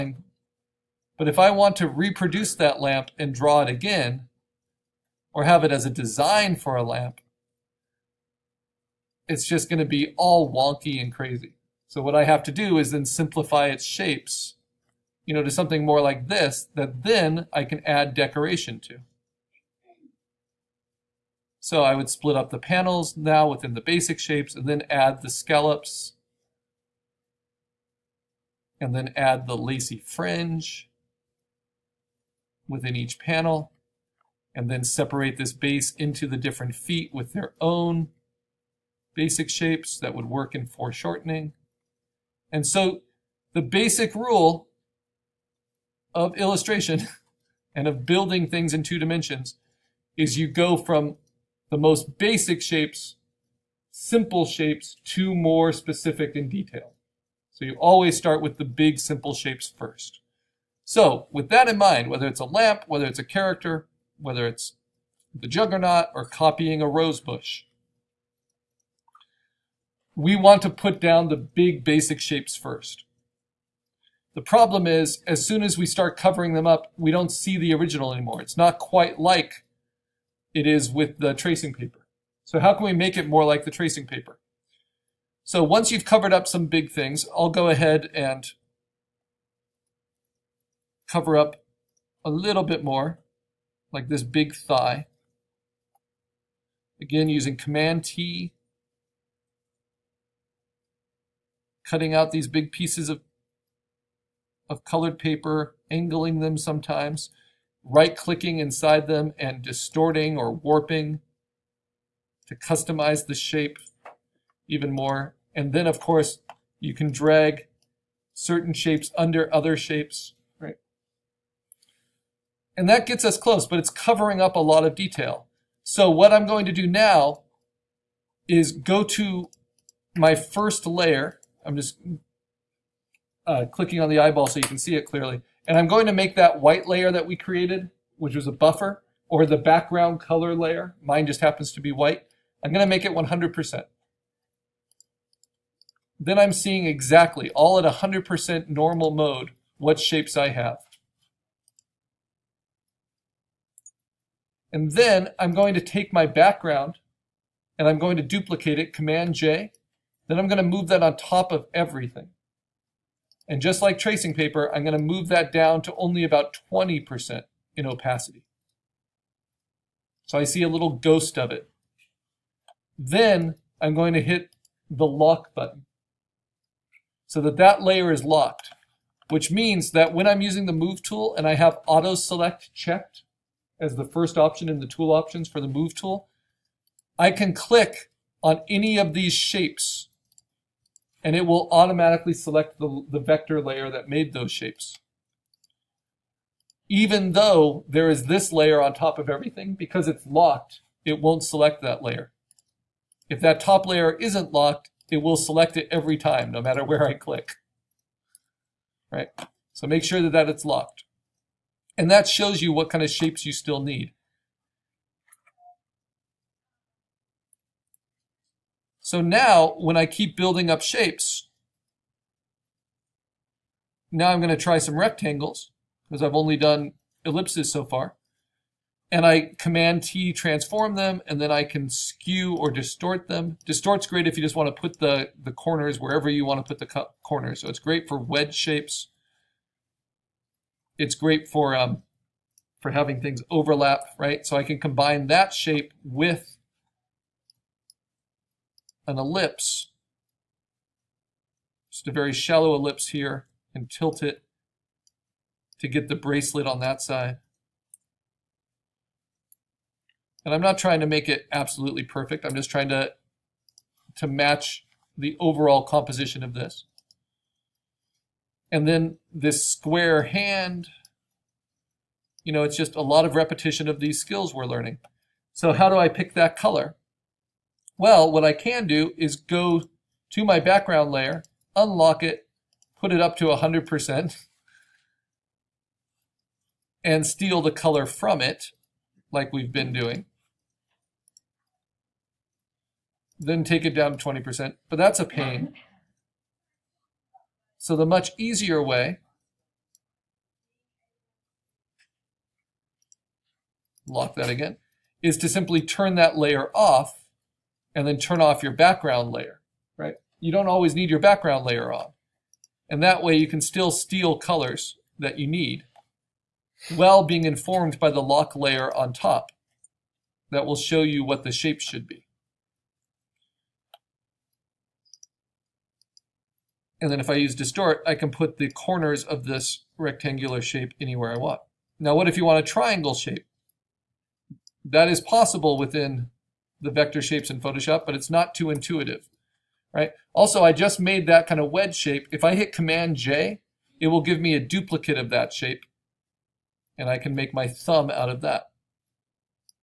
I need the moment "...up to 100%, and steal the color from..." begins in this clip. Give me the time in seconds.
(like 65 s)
283 s.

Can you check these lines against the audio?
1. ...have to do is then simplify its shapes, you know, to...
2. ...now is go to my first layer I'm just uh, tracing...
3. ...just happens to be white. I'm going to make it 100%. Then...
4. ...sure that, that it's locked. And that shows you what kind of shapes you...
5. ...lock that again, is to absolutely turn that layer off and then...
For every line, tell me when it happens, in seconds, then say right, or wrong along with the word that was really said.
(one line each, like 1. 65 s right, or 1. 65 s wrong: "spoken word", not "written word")
1. 12 s right
2. 126 s wrong: "clicking", not "tracing"
3. 141 s right
4. 210 s right
5. 304 s wrong: "simply", not "absolutely".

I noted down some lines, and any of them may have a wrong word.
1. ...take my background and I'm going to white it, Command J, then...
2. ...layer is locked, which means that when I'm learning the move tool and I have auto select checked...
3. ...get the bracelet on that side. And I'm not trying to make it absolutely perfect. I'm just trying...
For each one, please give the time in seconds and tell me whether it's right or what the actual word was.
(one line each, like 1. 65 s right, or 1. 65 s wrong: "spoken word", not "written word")
1. 155 s wrong: "duplicate", not "white"
2. 177 s wrong: "using", not "learning"
3. 255 s right.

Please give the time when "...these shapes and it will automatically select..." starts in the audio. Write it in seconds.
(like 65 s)
189 s.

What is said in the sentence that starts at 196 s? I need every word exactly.
Even though there is this layer on top of everything, because it's locked, it won't select that layer.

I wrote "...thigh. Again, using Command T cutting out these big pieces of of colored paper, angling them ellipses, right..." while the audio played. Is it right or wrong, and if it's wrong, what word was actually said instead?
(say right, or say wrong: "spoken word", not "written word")
wrong: "sometimes", not "ellipses".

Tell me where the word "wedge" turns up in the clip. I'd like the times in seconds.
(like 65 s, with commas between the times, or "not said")
238 s, 341 s.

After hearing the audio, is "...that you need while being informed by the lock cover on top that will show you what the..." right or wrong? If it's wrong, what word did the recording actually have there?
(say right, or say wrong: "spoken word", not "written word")
wrong: "layer", not "cover".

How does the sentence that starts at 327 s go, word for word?
And then if I use distort, I can put the corners of this rectangular shape anywhere I want.